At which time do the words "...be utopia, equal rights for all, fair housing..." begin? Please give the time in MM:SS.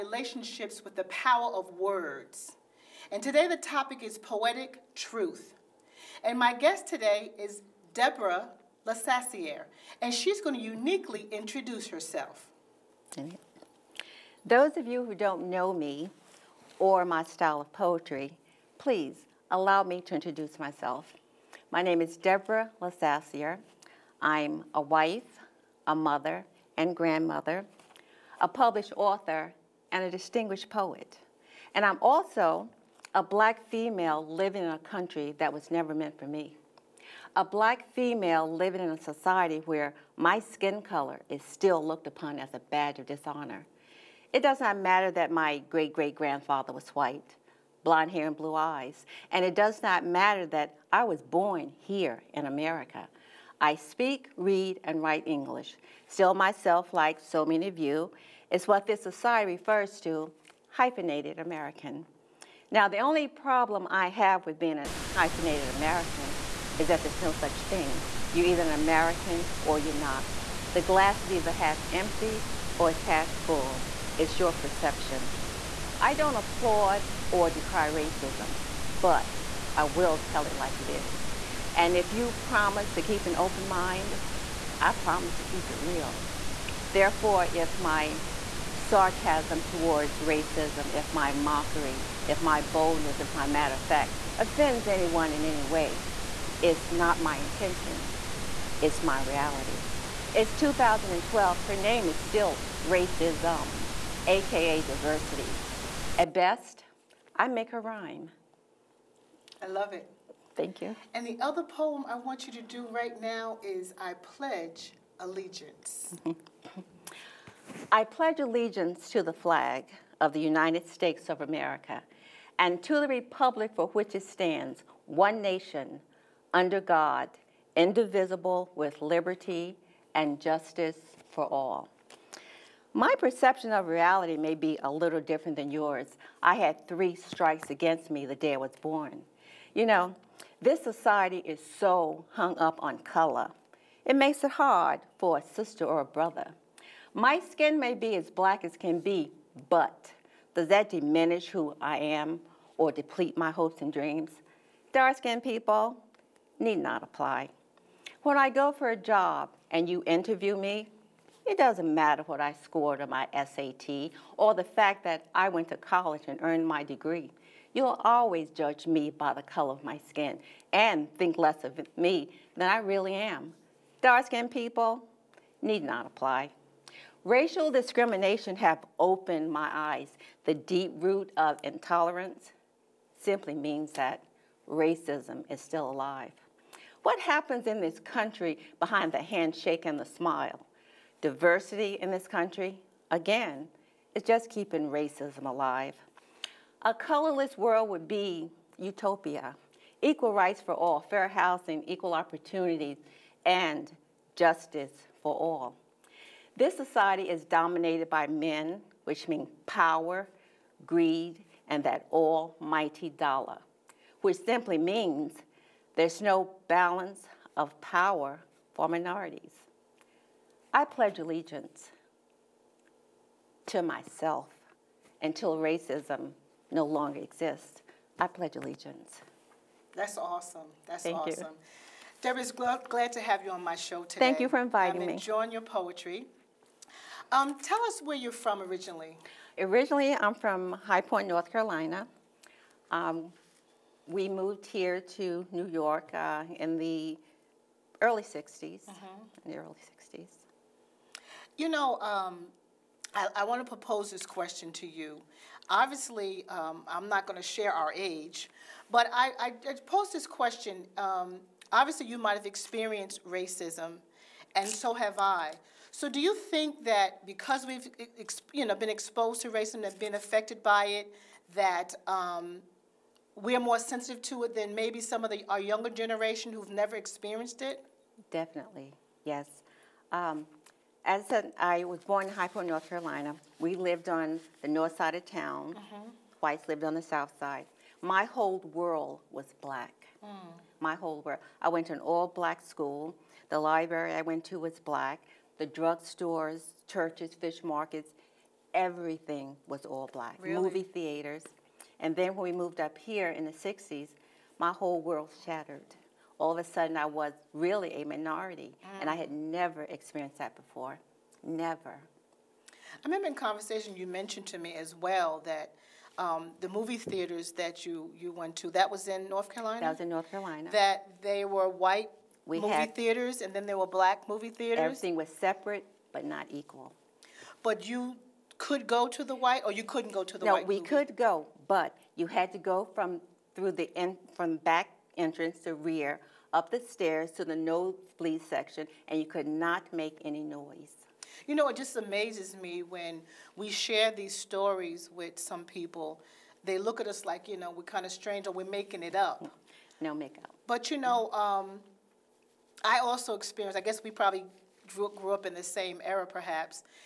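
03:18.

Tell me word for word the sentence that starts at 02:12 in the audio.
My perception of reality may be a little different than yours.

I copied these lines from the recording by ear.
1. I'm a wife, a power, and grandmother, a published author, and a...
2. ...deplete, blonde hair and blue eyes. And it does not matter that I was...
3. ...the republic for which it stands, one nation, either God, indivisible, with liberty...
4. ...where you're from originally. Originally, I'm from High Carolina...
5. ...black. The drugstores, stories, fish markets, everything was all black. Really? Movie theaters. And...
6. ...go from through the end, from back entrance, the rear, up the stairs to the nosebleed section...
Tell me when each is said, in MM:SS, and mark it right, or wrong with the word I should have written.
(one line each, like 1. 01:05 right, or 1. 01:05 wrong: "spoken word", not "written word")
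1. 00:24 wrong: "mother", not "power"
2. 00:46 wrong: "white", not "deplete"
3. 02:02 wrong: "under", not "either"
4. 03:58 wrong: "Point", not "Carolina"
5. 04:54 wrong: "churches", not "stories"
6. 05:32 right.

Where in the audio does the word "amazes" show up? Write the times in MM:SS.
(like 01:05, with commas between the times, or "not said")
05:41.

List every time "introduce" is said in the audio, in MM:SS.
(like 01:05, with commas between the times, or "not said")
00:11, 00:20.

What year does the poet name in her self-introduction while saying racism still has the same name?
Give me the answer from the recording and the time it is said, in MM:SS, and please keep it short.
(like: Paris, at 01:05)
2012, at 01:40.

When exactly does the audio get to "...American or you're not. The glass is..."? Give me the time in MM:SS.
01:08.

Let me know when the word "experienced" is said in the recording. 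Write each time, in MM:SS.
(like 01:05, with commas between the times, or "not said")
04:22, 04:36, 05:09, 05:53.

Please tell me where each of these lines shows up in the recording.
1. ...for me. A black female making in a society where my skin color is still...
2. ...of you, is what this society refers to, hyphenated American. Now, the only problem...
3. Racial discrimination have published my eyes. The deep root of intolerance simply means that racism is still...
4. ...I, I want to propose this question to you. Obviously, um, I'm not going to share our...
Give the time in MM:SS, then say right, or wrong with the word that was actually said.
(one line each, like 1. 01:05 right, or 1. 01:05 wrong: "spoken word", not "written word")
1. 00:36 wrong: "living", not "making"
2. 00:57 right
3. 02:57 wrong: "opened", not "published"
4. 04:13 right.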